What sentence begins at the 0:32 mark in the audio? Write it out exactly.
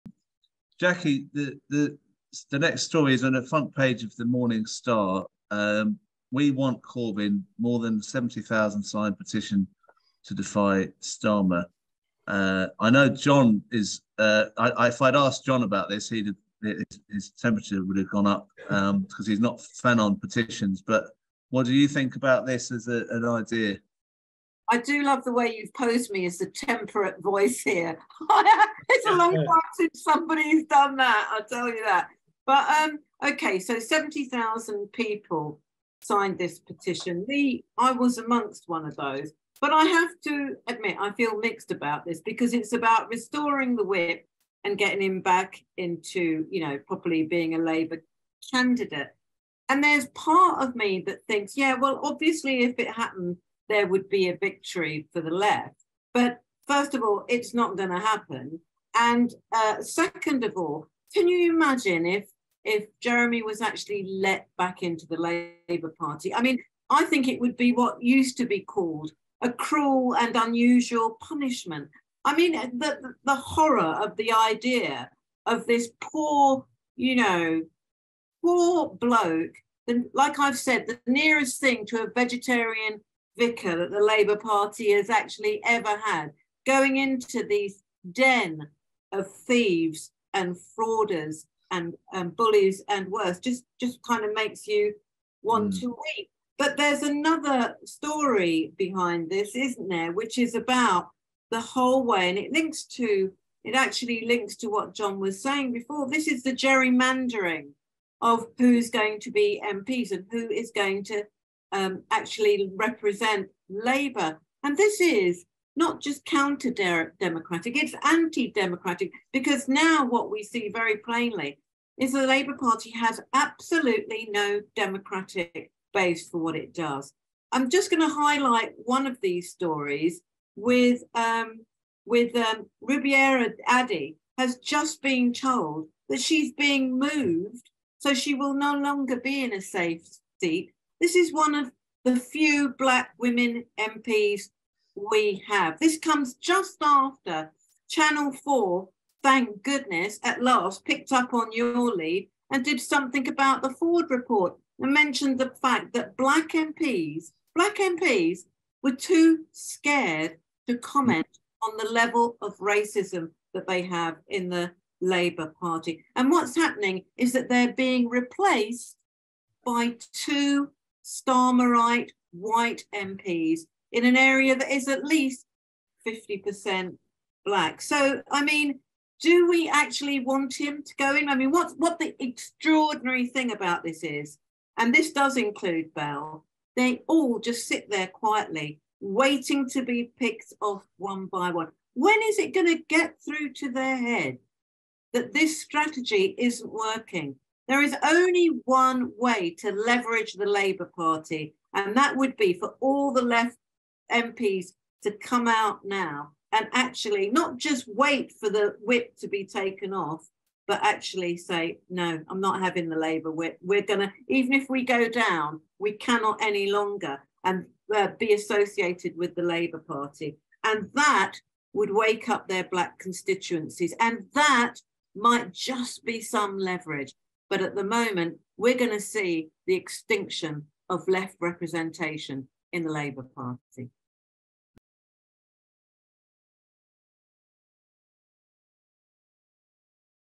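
But um, okay, so 70,000 people signed this petition.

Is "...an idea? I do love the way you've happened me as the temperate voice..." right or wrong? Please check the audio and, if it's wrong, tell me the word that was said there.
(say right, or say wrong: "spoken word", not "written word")
wrong: "posed", not "happened".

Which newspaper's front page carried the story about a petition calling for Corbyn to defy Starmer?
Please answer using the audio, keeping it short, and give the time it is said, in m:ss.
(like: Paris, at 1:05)
Morning Star, at 0:04.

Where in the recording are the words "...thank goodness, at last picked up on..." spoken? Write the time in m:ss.
2:29.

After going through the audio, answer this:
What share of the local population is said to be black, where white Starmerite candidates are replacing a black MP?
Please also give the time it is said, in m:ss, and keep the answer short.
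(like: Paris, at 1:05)
at least 50%, at 2:54.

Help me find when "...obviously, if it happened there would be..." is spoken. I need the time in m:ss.
0:52.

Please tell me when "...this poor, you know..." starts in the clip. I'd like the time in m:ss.
1:15.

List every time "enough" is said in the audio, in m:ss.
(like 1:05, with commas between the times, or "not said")
not said.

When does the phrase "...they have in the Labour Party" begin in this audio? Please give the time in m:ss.
2:43.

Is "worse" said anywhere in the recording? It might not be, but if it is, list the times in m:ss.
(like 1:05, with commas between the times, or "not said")
1:33.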